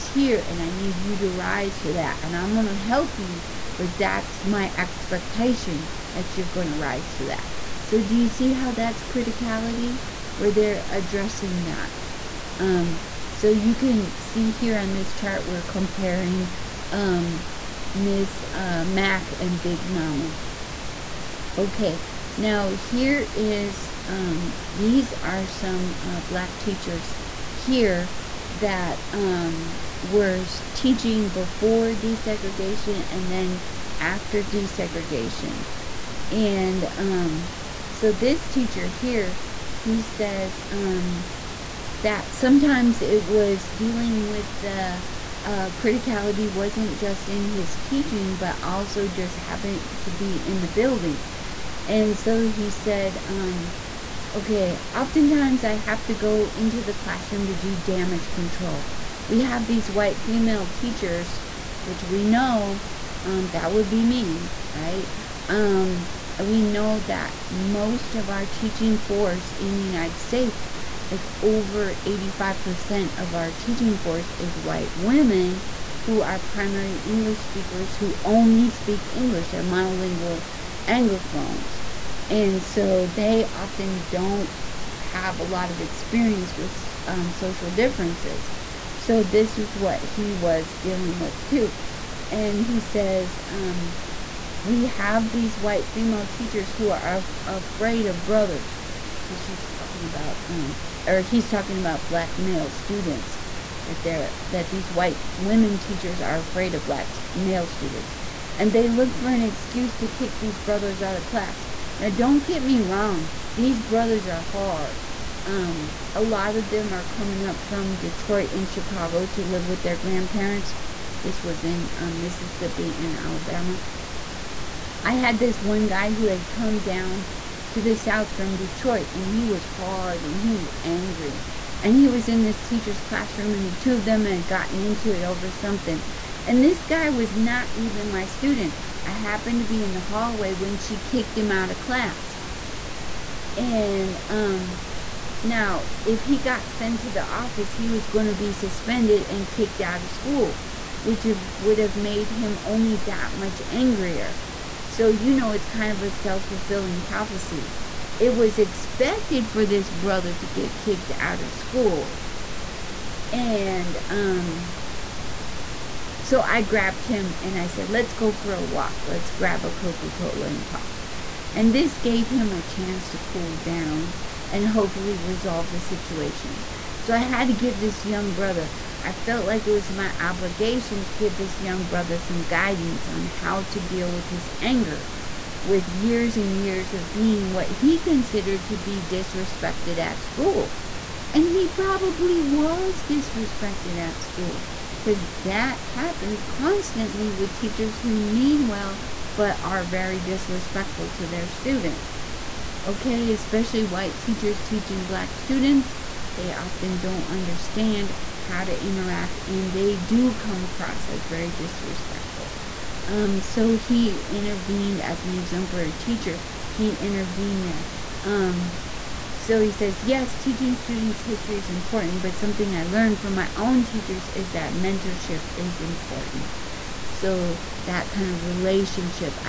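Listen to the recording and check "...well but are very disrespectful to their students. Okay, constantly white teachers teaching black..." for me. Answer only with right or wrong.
wrong.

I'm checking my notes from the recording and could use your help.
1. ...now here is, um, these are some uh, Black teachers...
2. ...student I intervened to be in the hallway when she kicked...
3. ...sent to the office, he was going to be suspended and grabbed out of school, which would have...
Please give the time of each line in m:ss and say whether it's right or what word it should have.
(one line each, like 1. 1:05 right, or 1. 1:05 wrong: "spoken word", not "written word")
1. 0:22 right
2. 2:18 wrong: "happened", not "intervened"
3. 2:26 wrong: "kicked", not "grabbed".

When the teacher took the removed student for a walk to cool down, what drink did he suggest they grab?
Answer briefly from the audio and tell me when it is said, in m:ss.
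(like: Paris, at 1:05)
Coca Cola, at 2:49.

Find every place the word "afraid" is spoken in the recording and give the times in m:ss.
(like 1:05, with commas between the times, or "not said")
1:37, 1:46.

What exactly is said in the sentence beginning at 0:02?
And I'm going to help you, but that's my expectation that you're going to rise to that.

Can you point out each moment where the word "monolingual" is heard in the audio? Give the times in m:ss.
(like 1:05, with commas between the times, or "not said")
1:19.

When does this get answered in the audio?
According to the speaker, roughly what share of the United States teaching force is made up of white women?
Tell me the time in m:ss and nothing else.
1:11.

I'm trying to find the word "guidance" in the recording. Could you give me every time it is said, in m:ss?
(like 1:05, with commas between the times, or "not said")
3:02.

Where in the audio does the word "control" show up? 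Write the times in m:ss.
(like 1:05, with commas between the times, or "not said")
0:58.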